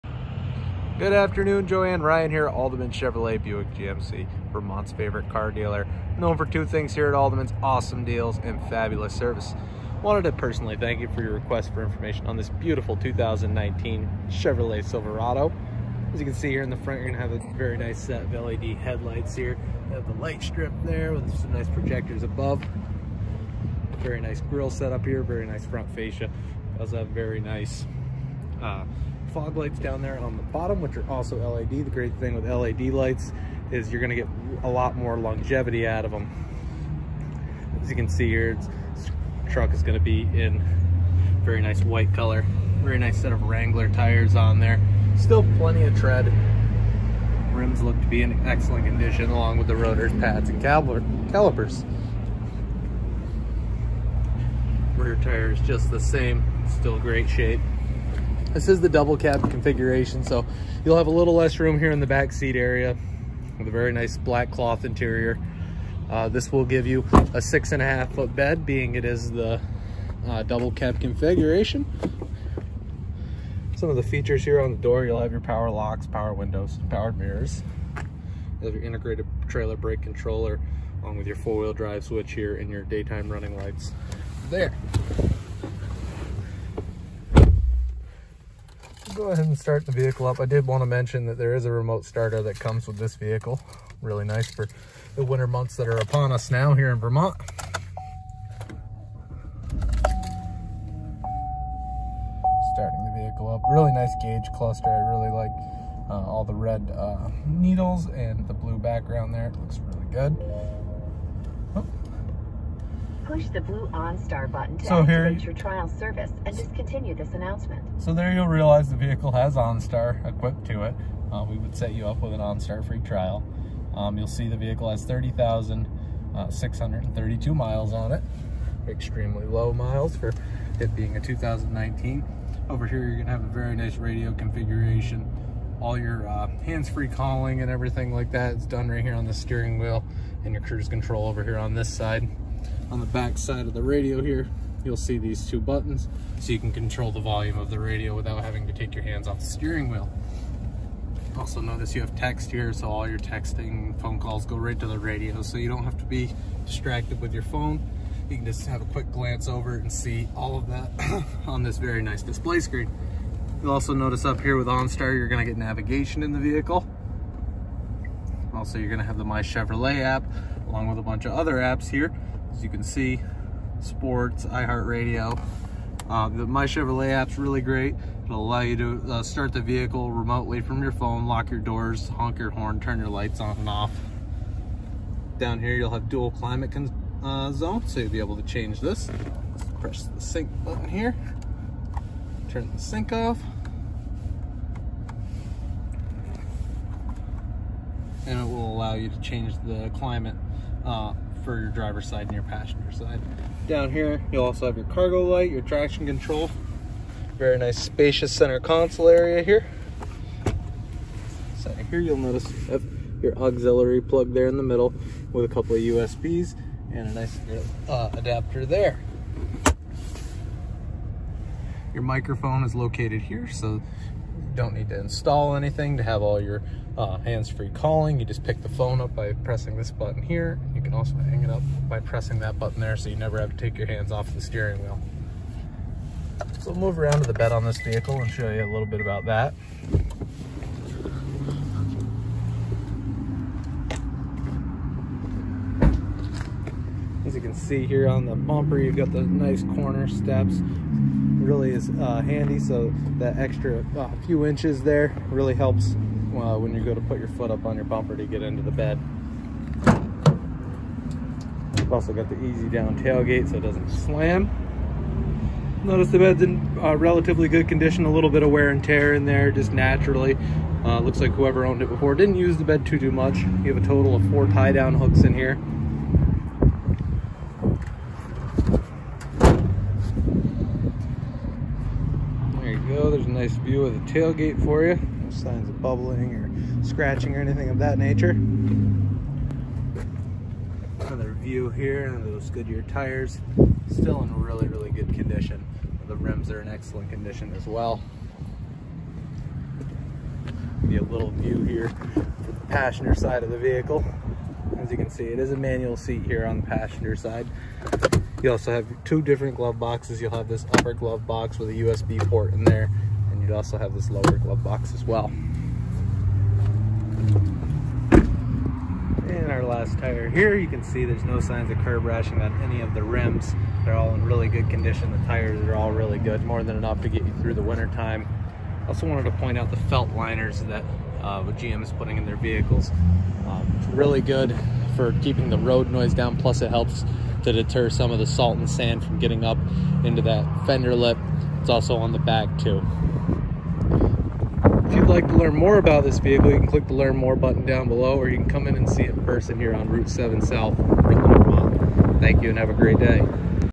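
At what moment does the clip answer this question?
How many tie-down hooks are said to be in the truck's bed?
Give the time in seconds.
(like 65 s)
274 s.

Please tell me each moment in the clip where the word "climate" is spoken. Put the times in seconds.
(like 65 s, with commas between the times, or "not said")
186 s, 199 s.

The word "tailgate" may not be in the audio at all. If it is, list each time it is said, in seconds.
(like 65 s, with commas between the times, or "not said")
263 s, 284 s.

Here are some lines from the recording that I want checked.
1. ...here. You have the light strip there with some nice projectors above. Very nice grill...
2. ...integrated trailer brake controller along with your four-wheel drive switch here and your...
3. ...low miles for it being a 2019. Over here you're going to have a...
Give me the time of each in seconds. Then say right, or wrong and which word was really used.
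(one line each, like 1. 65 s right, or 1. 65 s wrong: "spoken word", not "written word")
1. 19 s right
2. 78 s right
3. 129 s right.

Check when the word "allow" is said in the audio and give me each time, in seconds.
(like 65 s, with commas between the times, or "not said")
178 s, 198 s.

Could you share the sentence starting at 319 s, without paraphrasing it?
And our last tire here, you can see there's no signs of curb rashing on any of the rims.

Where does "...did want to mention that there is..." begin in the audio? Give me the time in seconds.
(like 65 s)
90 s.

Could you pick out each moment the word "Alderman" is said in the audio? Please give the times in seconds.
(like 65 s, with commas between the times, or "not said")
2 s, 7 s.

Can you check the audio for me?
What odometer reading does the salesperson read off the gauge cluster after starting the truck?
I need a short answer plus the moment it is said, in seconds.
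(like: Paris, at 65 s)
30,632 miles, at 125 s.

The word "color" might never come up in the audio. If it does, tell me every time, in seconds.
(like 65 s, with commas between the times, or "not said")
42 s.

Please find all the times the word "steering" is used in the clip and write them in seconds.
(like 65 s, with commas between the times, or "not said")
139 s, 149 s, 234 s.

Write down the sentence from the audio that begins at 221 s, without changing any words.
Your microphone is located here, so don't need to install anything to have all your uh, hands-free calling.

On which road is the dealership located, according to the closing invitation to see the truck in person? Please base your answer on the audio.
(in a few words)
Route 7 South.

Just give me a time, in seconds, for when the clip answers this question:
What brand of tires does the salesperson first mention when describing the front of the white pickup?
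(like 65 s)
43 s.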